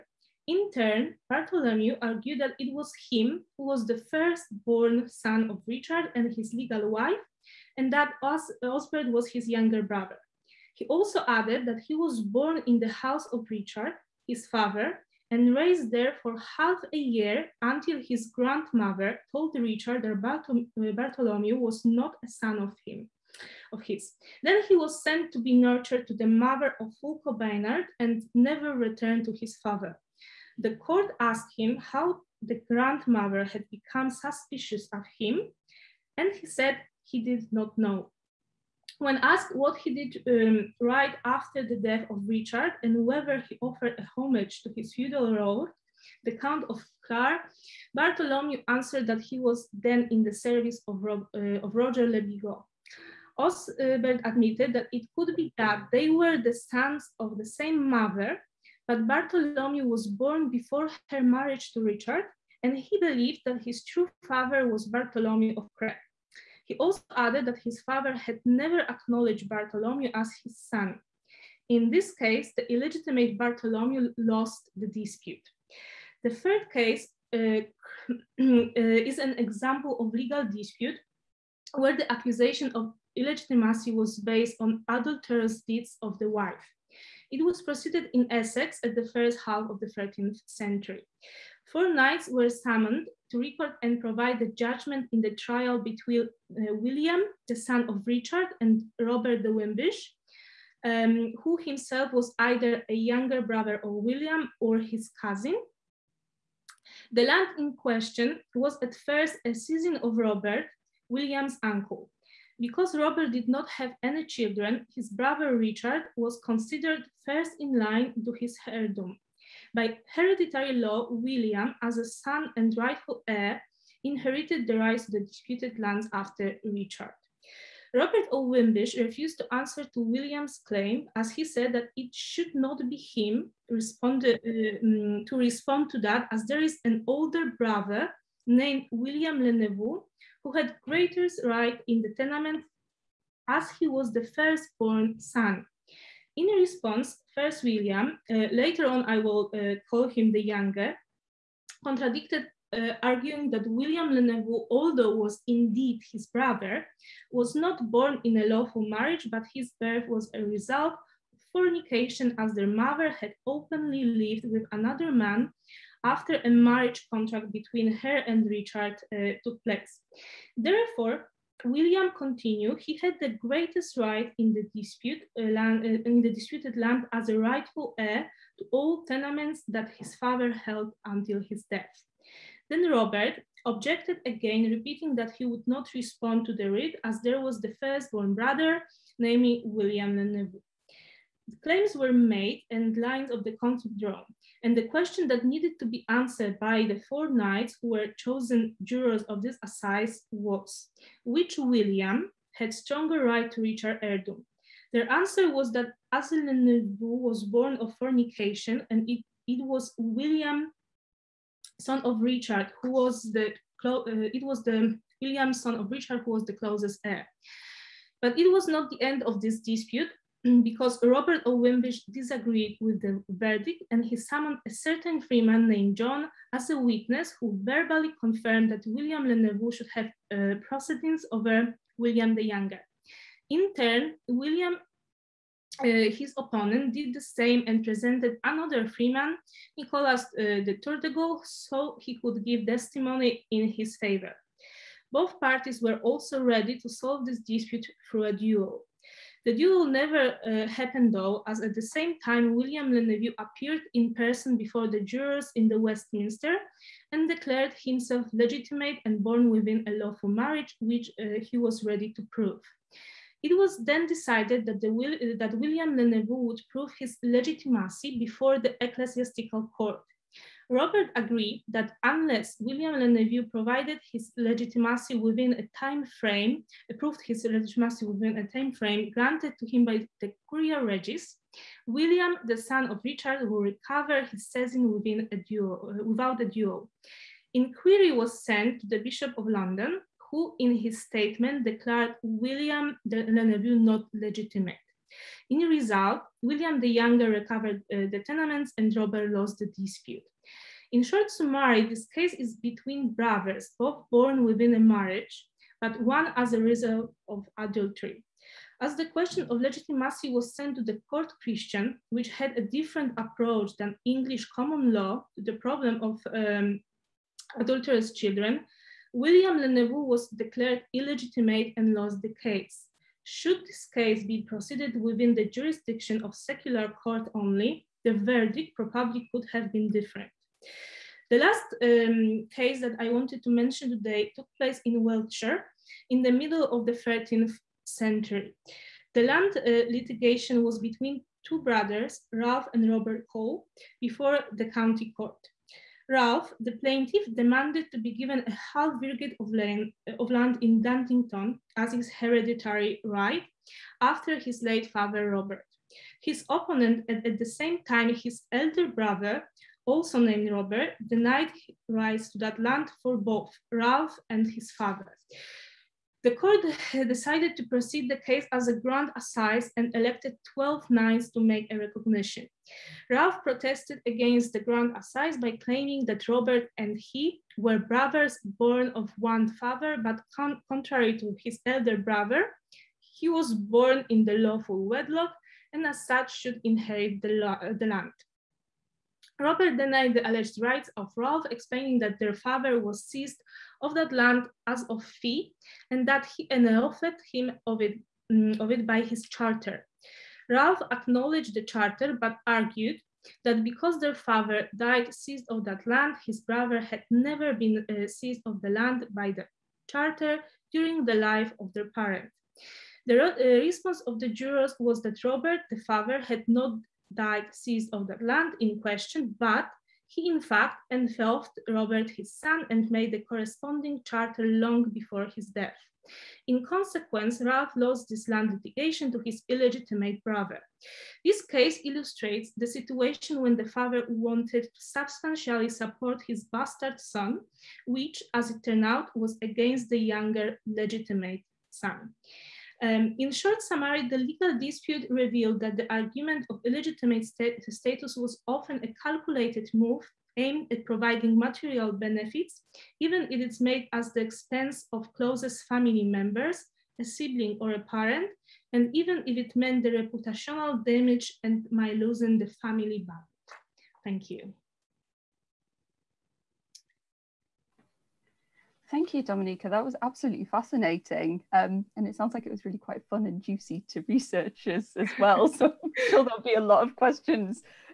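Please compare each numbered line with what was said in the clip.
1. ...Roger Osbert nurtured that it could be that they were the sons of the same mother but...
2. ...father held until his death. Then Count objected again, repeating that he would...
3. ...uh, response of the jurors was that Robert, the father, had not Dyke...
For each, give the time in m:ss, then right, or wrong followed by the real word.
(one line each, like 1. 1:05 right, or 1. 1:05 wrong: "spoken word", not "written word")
1. 0:51 wrong: "admitted", not "nurtured"
2. 3:00 wrong: "Robert", not "Count"
3. 6:53 right.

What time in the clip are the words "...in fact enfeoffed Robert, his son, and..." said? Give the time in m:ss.
7:00.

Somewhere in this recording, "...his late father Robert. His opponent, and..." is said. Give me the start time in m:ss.
5:54.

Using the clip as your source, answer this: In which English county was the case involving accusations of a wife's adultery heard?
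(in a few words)
Essex.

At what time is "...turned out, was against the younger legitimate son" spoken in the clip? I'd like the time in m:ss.
7:18.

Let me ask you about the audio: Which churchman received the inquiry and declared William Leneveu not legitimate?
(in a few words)
Bishop of London.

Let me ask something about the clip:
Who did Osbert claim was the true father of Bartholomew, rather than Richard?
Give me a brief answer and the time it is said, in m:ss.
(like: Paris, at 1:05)
Bartholomew of Crete, at 1:04.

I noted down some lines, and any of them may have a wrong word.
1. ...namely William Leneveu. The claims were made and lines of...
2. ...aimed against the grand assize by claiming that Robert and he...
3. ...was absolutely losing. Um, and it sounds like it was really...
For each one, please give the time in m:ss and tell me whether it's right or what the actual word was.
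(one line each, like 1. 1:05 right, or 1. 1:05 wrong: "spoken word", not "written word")
1. 3:09 right
2. 6:13 wrong: "protested", not "aimed"
3. 7:49 wrong: "fascinating", not "losing".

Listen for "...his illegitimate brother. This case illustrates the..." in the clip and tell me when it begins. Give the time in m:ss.
7:09.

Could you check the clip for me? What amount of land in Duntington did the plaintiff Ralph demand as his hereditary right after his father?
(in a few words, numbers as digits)
half virgate.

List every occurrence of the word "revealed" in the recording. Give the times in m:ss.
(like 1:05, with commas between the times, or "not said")
7:25.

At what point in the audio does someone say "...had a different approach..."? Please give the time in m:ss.
5:12.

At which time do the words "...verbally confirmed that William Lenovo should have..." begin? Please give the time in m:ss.
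3:47.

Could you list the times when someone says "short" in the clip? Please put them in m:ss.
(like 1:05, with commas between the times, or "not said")
5:01, 7:23.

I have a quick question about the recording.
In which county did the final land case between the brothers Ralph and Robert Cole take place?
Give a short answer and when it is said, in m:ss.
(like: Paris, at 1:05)
Wiltshire, at 5:35.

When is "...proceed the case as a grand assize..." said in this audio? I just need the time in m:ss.
6:07.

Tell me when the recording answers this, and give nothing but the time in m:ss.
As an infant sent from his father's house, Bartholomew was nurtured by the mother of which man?
0:27.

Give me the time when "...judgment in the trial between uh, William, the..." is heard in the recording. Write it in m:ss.
1:34.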